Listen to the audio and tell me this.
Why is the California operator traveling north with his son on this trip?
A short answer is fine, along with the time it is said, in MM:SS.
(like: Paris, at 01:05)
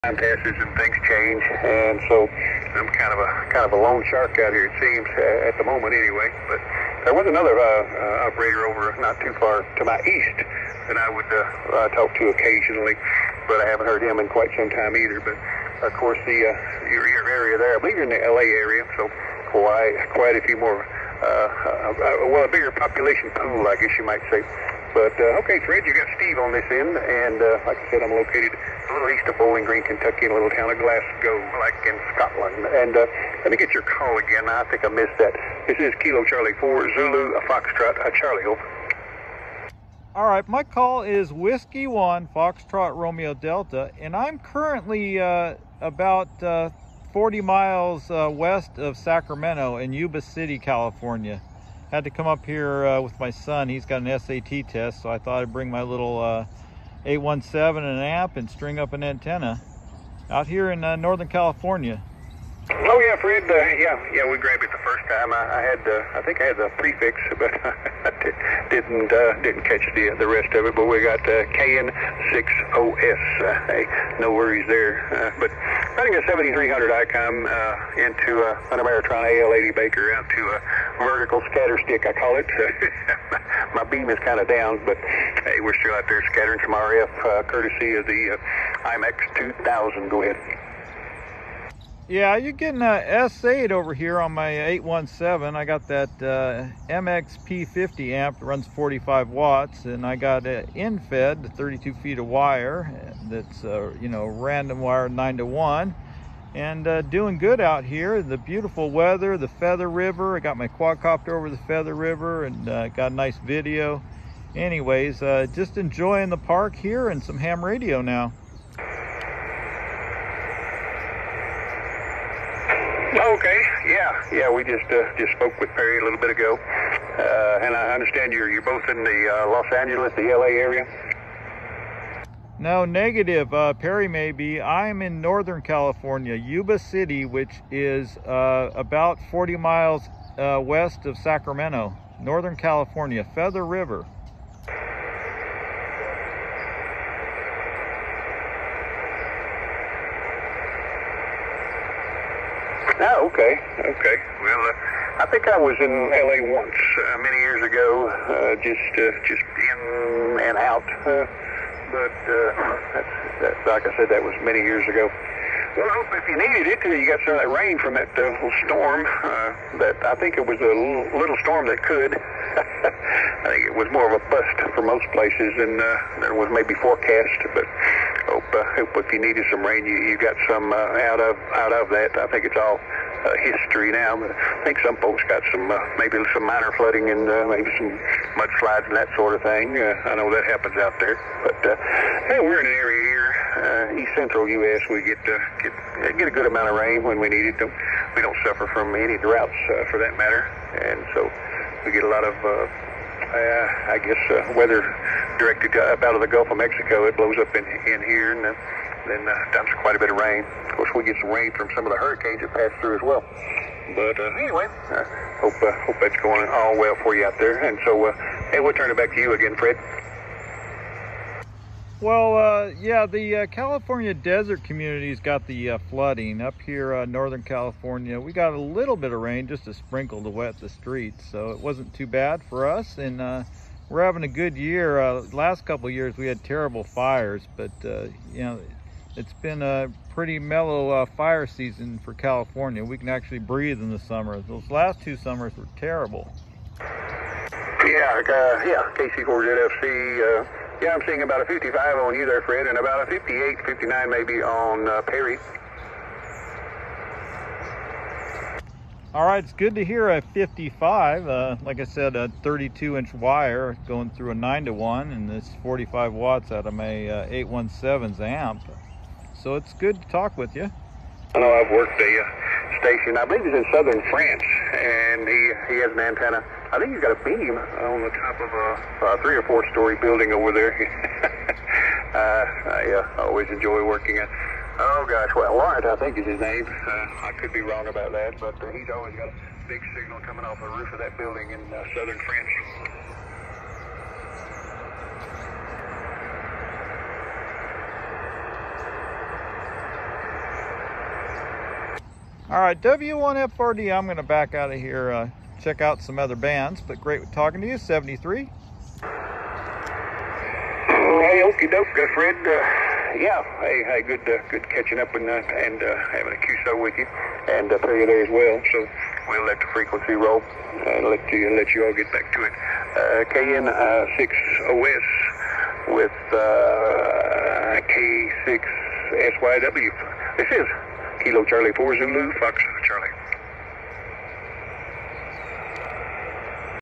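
SAT test, at 00:54.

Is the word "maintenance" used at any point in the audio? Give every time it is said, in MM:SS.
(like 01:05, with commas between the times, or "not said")
not said.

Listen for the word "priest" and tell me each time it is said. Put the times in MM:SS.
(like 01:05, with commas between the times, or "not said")
not said.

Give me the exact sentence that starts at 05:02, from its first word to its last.
All right, W1FRD, I'm going to back out of here, uh, check out some other bands, but great talking to you, 73.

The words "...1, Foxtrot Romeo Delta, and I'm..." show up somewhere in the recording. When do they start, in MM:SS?
00:41.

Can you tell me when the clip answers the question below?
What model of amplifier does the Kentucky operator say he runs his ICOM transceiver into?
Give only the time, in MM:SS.
01:18.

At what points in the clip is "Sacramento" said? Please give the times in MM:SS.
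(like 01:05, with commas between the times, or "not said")
00:48, 02:21.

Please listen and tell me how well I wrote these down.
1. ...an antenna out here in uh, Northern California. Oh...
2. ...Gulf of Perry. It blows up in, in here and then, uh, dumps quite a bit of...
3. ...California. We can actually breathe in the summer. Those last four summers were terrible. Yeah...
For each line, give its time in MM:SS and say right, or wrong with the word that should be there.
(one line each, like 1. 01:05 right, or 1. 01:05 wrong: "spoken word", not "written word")
1. 00:58 right
2. 03:26 wrong: "Mexico", not "Perry"
3. 04:02 wrong: "two", not "four".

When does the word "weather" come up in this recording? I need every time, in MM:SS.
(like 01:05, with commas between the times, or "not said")
01:48, 03:24.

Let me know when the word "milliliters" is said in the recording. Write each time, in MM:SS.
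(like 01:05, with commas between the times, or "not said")
not said.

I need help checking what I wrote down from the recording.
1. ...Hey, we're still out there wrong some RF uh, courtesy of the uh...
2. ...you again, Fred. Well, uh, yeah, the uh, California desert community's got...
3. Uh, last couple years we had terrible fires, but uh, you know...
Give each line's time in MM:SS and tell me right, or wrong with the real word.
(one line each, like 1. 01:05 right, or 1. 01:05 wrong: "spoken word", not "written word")
1. 01:25 wrong: "scattering", not "wrong"
2. 03:39 right
3. 03:55 right.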